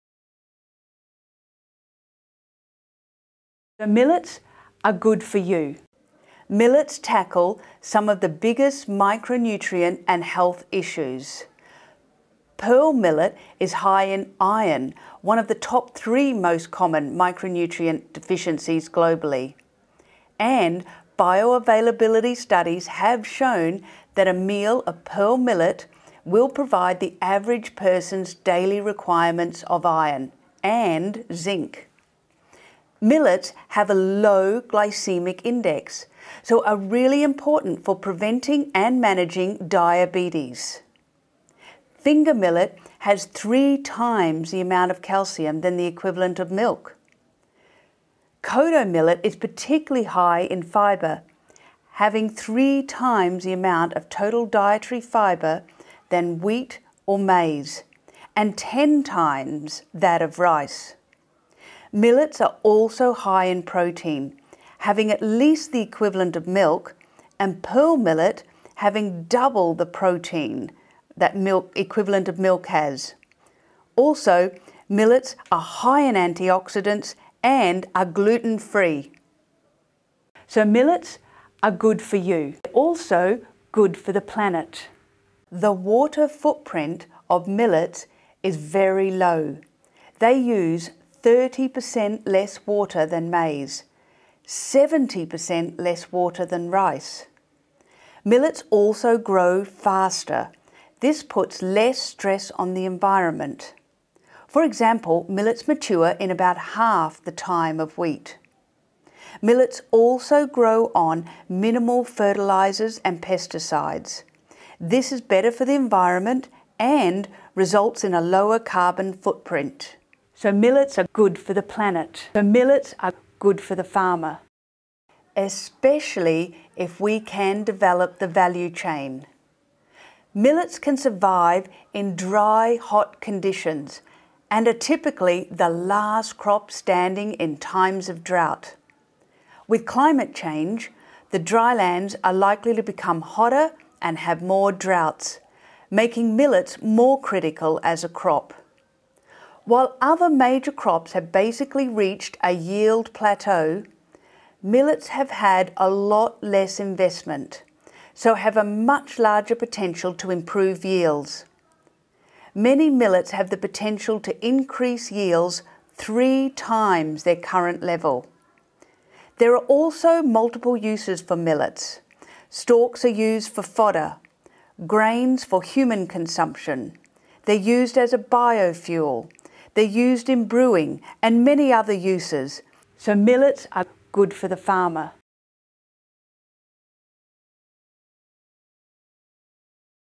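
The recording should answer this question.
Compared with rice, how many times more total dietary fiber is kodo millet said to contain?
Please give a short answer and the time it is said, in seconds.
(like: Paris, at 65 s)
10 times, at 58 s.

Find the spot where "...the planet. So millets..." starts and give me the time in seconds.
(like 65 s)
121 s.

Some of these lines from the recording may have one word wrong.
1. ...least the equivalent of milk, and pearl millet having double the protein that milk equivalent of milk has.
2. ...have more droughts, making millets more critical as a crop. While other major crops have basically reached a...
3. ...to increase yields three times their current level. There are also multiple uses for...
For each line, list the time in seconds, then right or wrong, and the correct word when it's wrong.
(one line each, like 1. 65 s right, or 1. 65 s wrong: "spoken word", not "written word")
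1. 65 s right
2. 144 s right
3. 164 s right.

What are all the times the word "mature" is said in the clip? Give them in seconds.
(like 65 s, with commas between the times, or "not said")
105 s.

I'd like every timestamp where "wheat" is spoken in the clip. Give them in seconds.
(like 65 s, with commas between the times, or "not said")
56 s, 107 s.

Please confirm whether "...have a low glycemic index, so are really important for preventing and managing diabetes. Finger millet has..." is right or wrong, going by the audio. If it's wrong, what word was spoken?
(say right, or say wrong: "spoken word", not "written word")
right.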